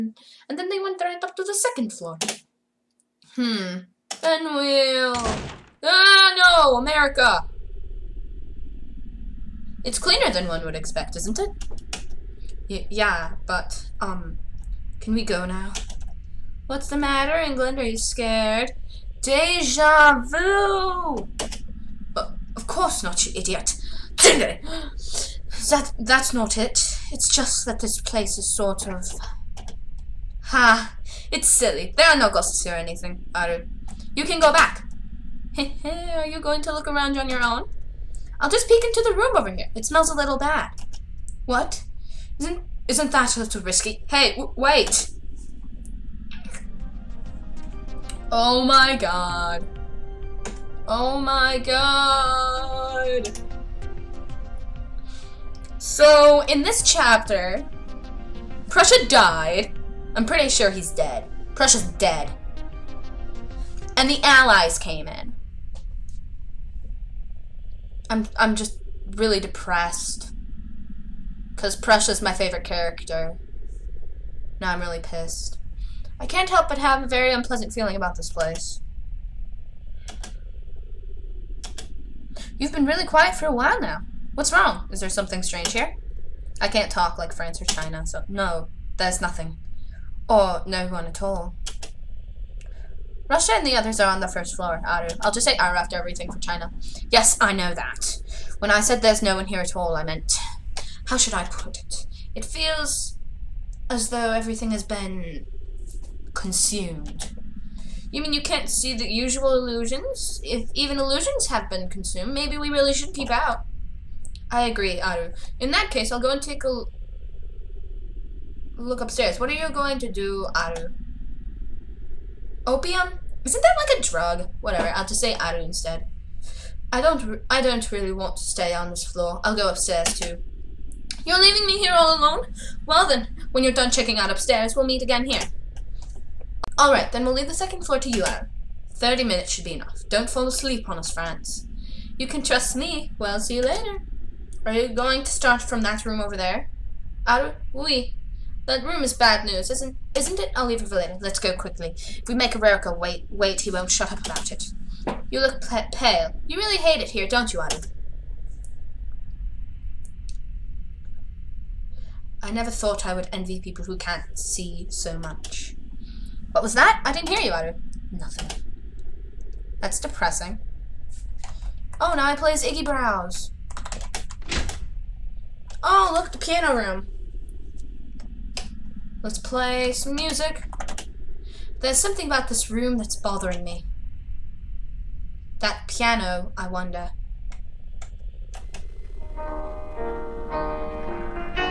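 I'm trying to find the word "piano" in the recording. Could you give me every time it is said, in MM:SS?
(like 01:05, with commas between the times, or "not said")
02:56, 03:05.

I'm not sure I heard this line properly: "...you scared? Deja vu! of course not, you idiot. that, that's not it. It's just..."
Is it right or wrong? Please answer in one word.
right.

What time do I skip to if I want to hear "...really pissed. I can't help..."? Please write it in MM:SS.
01:14.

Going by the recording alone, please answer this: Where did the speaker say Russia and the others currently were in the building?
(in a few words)
first floor.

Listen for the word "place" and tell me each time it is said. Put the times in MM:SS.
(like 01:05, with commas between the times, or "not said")
00:28, 01:18.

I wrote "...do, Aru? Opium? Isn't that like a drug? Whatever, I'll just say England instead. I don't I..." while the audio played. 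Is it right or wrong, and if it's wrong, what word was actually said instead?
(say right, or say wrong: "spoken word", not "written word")
wrong: "Aru", not "England".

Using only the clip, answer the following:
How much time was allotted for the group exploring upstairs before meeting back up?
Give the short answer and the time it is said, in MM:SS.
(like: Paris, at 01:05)
30 minutes, at 02:18.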